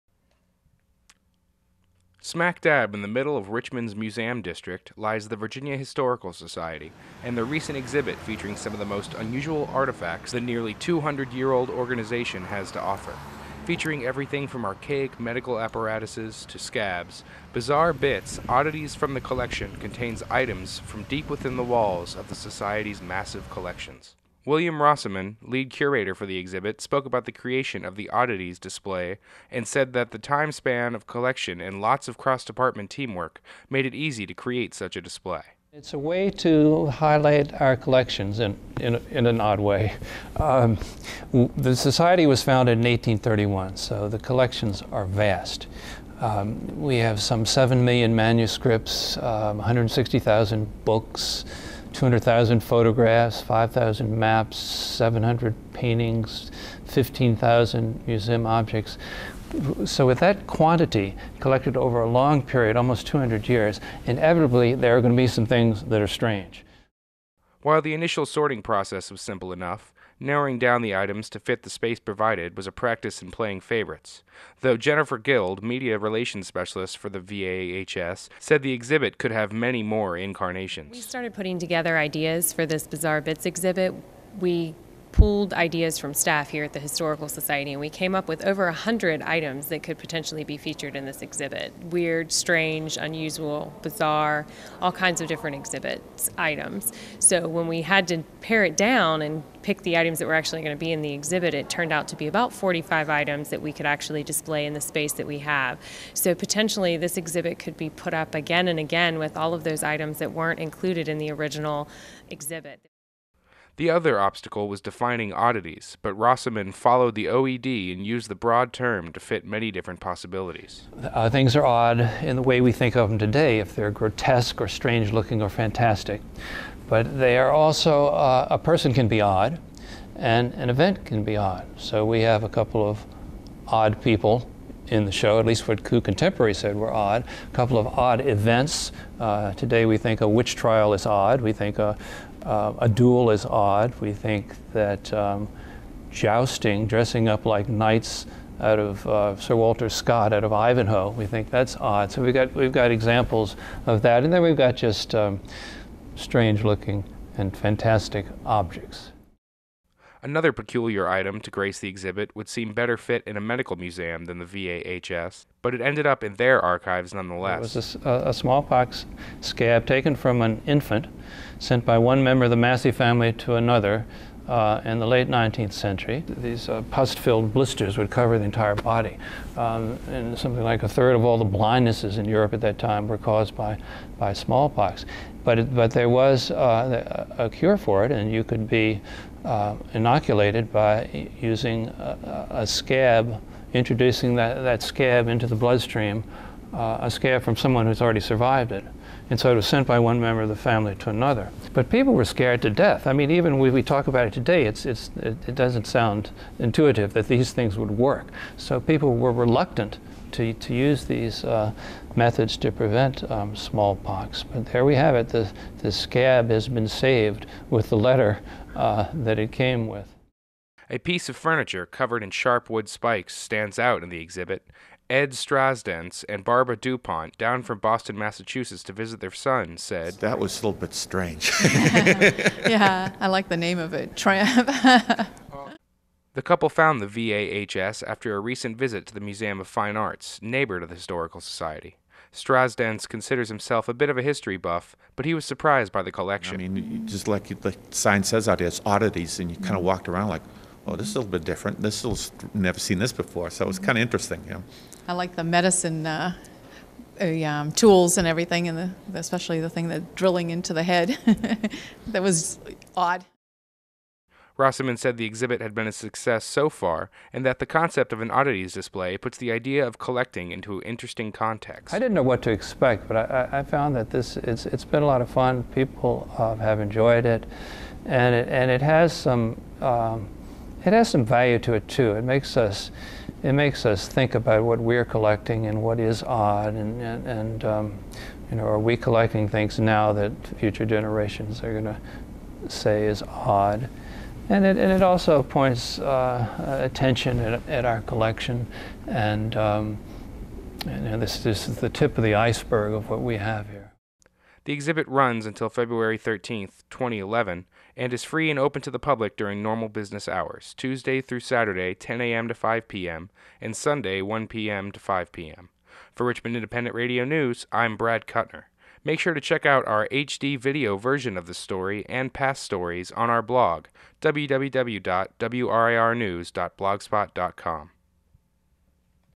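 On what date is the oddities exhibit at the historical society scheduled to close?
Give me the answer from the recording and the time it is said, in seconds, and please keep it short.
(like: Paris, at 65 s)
February 13, 2011, at 305 s.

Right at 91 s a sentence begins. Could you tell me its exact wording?
Weird, strange, unusual, bizarre, all kinds of different exhibits items.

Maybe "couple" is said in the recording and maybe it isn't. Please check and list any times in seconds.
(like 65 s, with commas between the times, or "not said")
132 s, 137 s, 236 s.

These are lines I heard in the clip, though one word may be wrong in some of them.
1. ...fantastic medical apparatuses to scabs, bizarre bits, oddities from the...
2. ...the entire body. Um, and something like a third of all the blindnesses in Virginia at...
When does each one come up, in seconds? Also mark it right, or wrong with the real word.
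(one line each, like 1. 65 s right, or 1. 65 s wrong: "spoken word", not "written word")
1. 14 s wrong: "archaic", not "fantastic"
2. 178 s wrong: "Europe", not "Virginia".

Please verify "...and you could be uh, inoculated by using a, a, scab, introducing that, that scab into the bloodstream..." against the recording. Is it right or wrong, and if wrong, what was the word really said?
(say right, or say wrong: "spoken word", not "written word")
right.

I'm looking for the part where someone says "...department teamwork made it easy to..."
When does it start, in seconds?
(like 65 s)
32 s.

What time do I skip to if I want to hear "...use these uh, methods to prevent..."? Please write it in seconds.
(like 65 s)
210 s.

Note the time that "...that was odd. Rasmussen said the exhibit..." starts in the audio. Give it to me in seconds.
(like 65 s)
262 s.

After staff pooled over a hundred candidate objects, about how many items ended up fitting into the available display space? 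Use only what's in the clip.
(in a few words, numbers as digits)
45.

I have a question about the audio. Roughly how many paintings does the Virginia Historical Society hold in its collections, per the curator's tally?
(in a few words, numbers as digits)
700.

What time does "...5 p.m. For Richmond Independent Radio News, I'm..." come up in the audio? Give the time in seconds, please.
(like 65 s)
314 s.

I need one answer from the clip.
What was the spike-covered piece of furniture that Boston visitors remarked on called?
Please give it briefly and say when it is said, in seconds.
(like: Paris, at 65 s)
Tramp, at 234 s.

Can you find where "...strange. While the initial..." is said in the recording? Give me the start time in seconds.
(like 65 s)
66 s.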